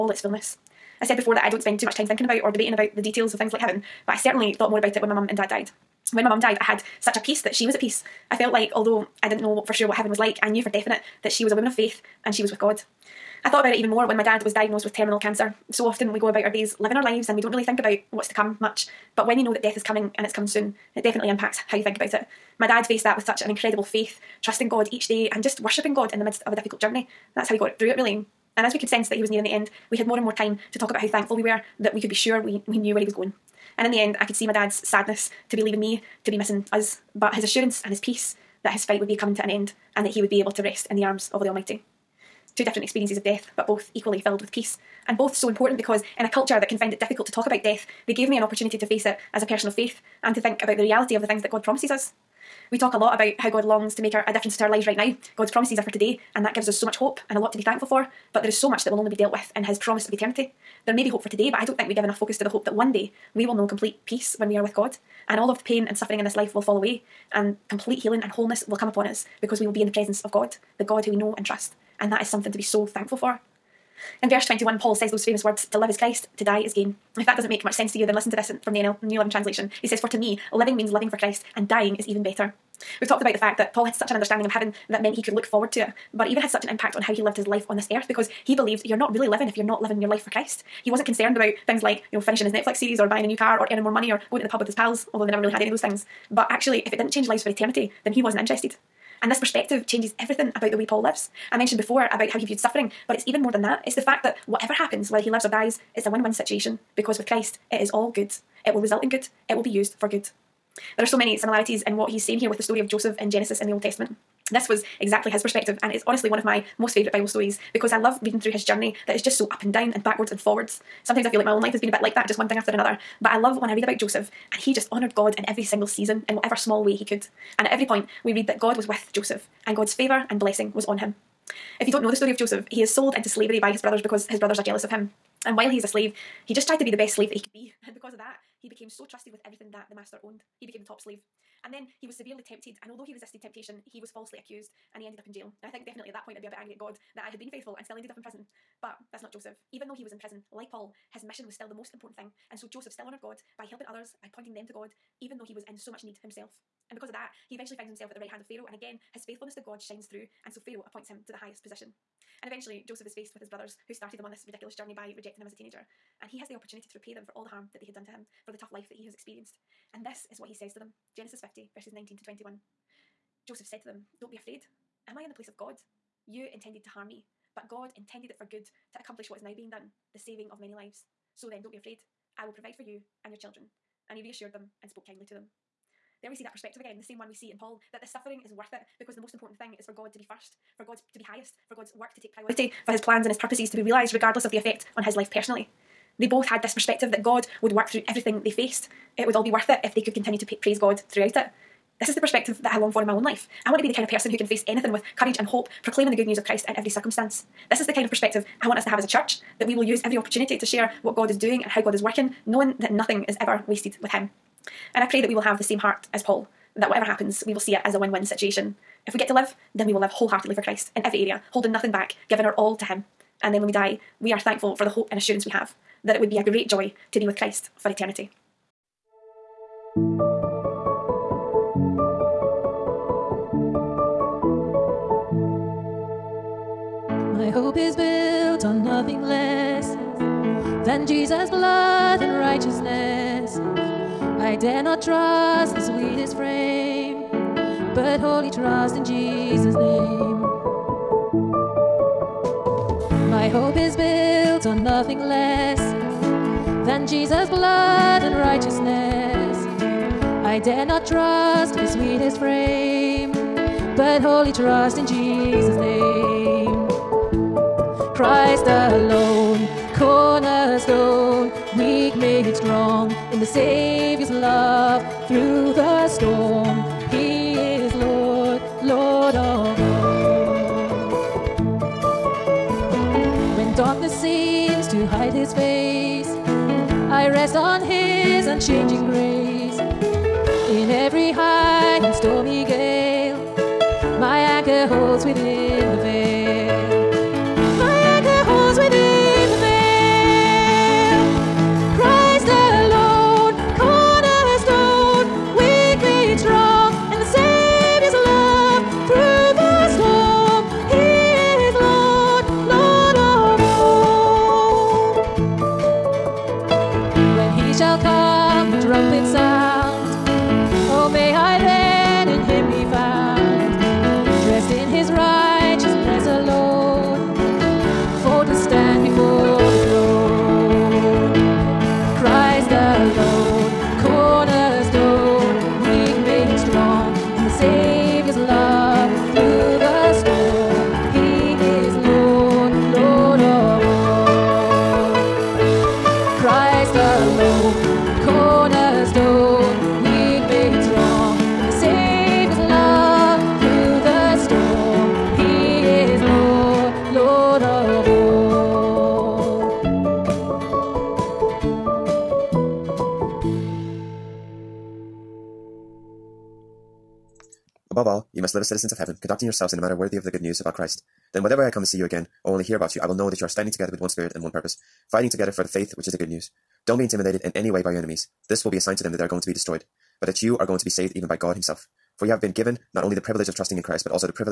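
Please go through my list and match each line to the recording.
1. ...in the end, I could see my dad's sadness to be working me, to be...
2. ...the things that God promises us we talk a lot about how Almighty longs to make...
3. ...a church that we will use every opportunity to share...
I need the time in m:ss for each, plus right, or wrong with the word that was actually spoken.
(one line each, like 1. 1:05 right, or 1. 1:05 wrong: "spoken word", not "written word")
1. 0:33 wrong: "leaving", not "working"
2. 0:51 wrong: "God", not "Almighty"
3. 3:29 right.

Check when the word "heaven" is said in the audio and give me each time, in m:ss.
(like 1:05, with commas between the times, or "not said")
0:03, 0:09, 1:24, 6:08.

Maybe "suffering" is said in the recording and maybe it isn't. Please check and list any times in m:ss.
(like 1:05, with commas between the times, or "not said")
1:05, 1:42, 3:08.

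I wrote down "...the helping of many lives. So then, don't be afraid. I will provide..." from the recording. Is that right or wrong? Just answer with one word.
wrong.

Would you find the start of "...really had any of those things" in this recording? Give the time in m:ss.
1:35.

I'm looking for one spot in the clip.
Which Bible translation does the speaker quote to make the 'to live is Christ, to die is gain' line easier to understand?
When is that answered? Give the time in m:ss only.
1:19.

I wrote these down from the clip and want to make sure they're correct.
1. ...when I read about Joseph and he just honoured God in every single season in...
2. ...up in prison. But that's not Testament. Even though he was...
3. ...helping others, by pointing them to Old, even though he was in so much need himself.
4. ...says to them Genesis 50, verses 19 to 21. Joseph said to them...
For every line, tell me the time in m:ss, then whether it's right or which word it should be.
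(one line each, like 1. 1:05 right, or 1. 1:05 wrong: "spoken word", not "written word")
1. 2:03 right
2. 2:28 wrong: "Joseph", not "Testament"
3. 2:33 wrong: "God", not "Old"
4. 2:50 right.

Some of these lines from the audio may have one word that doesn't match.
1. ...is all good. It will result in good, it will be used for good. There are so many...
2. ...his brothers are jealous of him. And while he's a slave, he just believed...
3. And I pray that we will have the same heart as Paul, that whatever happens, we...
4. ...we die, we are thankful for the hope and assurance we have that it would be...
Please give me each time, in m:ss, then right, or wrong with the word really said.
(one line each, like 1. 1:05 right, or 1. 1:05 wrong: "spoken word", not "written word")
1. 1:47 right
2. 2:14 wrong: "tried", not "believed"
3. 3:34 right
4. 3:43 right.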